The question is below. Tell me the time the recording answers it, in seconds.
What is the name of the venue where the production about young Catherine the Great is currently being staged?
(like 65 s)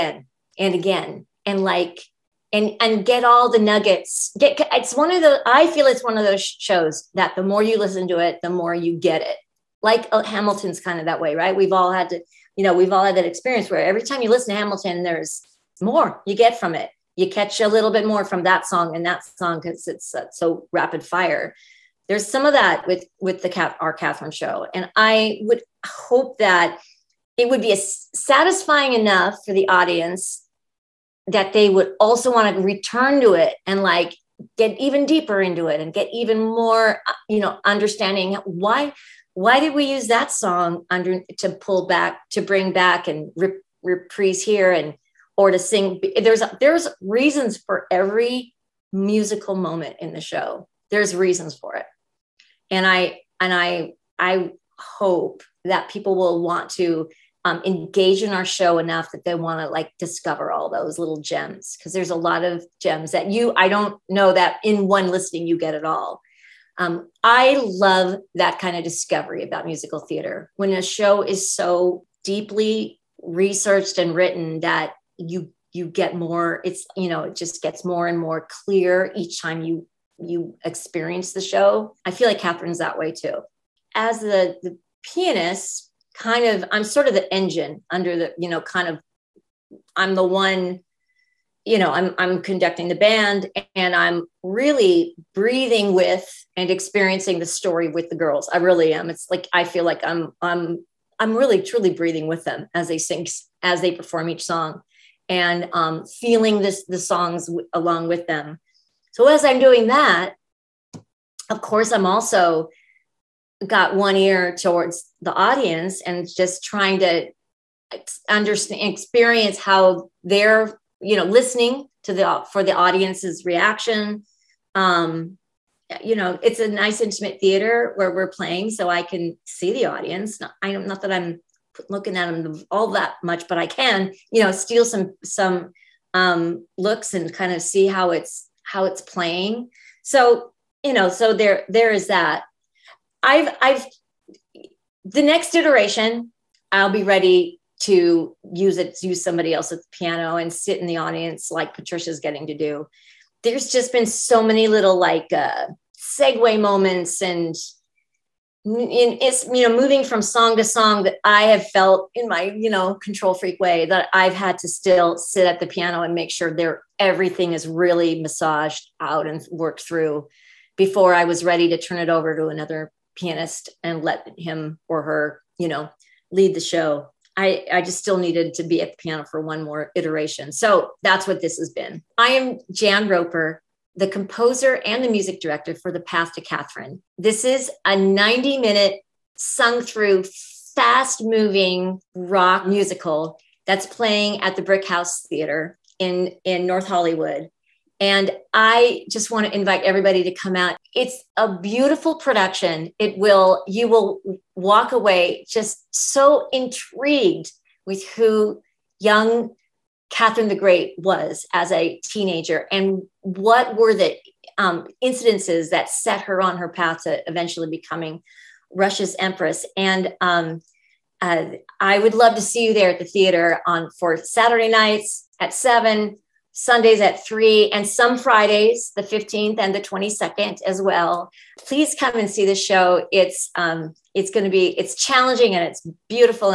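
194 s.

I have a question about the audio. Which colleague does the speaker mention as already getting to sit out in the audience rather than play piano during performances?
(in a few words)
Patricia.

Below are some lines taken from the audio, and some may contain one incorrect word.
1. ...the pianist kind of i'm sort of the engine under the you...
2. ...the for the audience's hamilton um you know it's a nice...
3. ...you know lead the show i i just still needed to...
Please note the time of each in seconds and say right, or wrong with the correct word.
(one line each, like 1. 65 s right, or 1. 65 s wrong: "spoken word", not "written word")
1. 84 s right
2. 122 s wrong: "reaction", not "hamilton"
3. 175 s right.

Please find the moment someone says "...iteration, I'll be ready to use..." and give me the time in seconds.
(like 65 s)
145 s.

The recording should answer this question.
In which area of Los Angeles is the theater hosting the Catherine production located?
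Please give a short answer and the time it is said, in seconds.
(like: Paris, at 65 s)
North Hollywood, at 196 s.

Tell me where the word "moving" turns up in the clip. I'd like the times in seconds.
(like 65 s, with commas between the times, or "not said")
159 s, 191 s.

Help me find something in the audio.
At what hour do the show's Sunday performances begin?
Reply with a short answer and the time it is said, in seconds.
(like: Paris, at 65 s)
3, at 227 s.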